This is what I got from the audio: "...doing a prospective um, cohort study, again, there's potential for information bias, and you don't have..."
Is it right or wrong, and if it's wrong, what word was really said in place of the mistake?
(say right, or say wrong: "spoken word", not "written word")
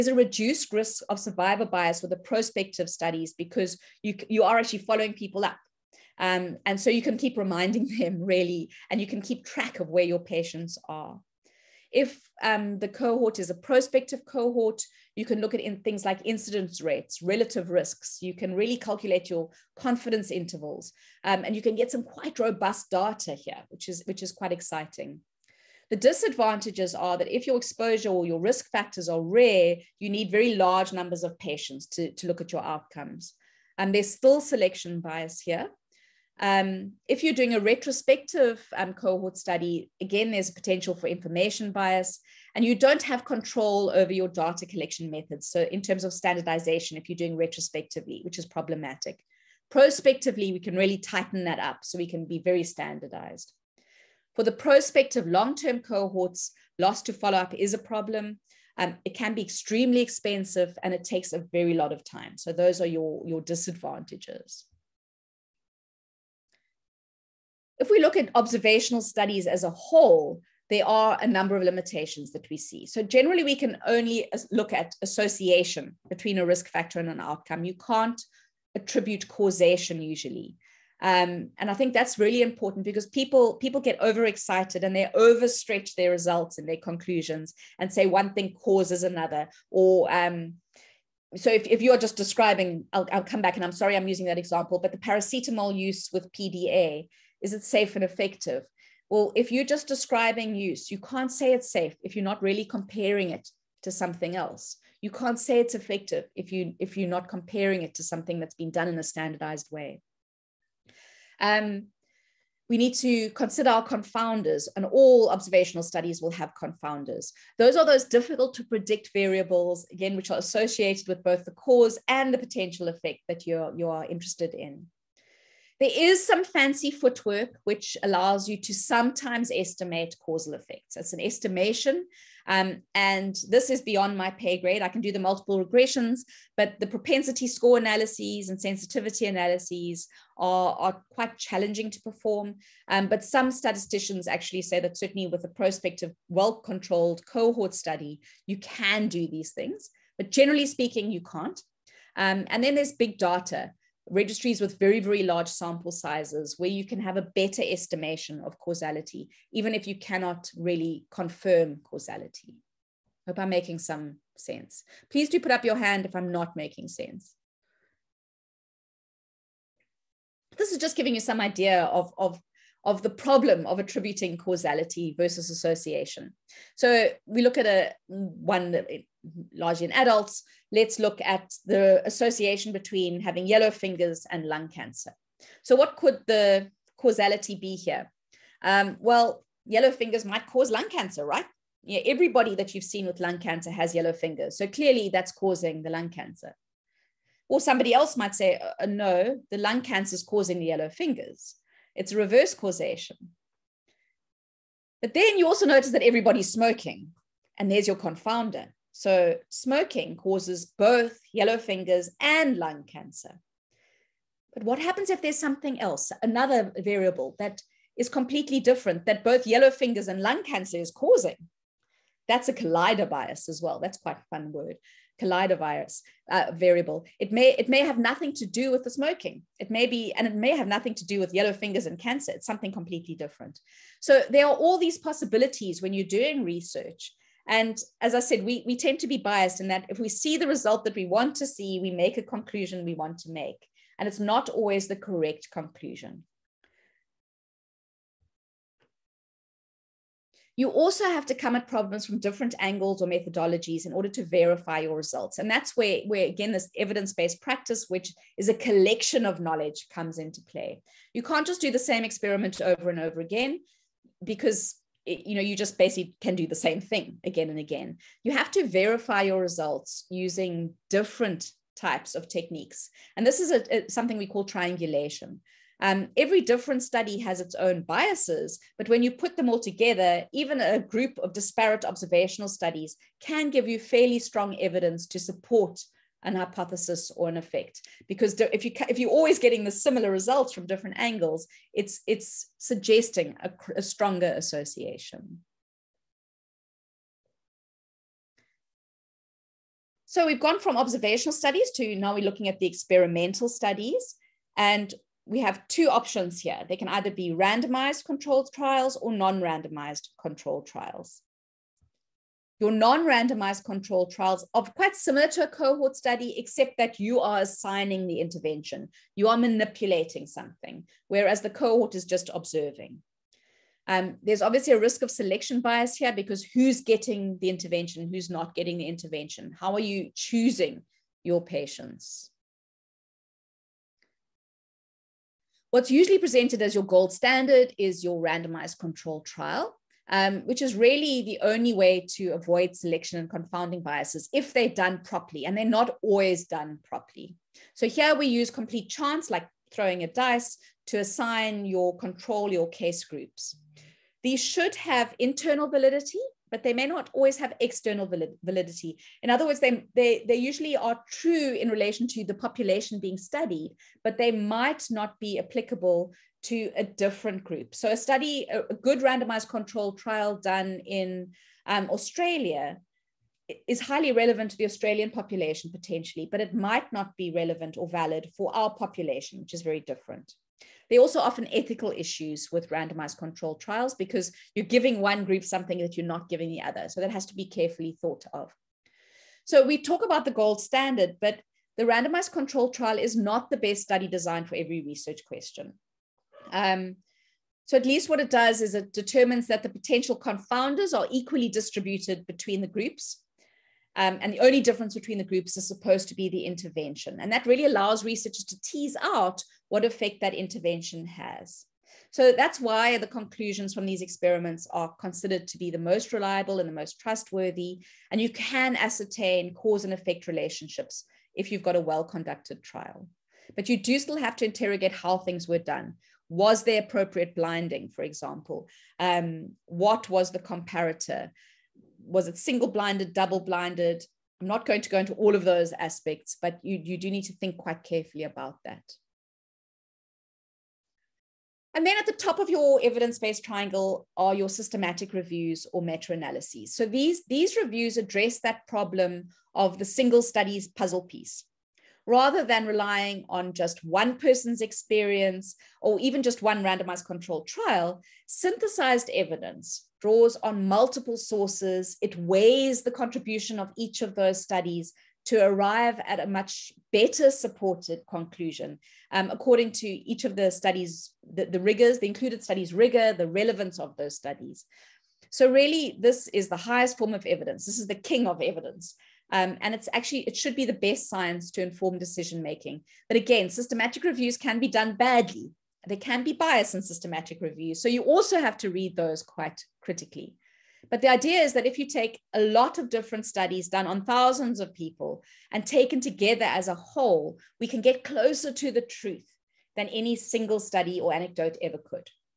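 wrong: "retrospective", not "prospective".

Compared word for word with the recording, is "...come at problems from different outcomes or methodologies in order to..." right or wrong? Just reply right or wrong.
wrong.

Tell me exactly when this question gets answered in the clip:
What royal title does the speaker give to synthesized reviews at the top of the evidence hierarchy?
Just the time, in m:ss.
7:57.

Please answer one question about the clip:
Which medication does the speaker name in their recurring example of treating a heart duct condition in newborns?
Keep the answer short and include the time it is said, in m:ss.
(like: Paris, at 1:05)
paracetamol, at 1:34.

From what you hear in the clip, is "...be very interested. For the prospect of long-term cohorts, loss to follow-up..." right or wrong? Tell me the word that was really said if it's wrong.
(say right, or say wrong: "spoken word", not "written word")
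wrong: "standardized", not "interested".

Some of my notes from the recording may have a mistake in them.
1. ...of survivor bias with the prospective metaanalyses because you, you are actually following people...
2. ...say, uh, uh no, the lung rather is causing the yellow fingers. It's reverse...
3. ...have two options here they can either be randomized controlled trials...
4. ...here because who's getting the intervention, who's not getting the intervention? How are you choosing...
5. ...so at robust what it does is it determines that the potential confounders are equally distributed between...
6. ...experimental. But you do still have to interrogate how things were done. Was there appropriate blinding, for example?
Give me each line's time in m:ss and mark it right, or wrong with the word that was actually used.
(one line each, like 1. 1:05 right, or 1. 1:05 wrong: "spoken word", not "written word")
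1. 0:01 wrong: "studies", not "metaanalyses"
2. 3:18 wrong: "cancer", not "rather"
3. 5:05 right
4. 5:25 right
5. 6:37 wrong: "least", not "robust"
6. 7:02 wrong: "trial", not "experimental".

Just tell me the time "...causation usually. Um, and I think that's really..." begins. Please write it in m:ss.
1:19.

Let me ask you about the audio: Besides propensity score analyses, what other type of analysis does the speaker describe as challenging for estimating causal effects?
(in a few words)
sensitivity analyses.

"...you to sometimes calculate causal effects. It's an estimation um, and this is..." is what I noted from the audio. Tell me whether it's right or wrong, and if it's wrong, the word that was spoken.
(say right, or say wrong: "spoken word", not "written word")
wrong: "estimate", not "calculate".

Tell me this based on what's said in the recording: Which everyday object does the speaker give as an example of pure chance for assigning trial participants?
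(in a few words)
a dice.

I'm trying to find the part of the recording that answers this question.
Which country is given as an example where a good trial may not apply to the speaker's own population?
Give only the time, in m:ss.
6:11.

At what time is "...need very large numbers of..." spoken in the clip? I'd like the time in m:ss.
0:30.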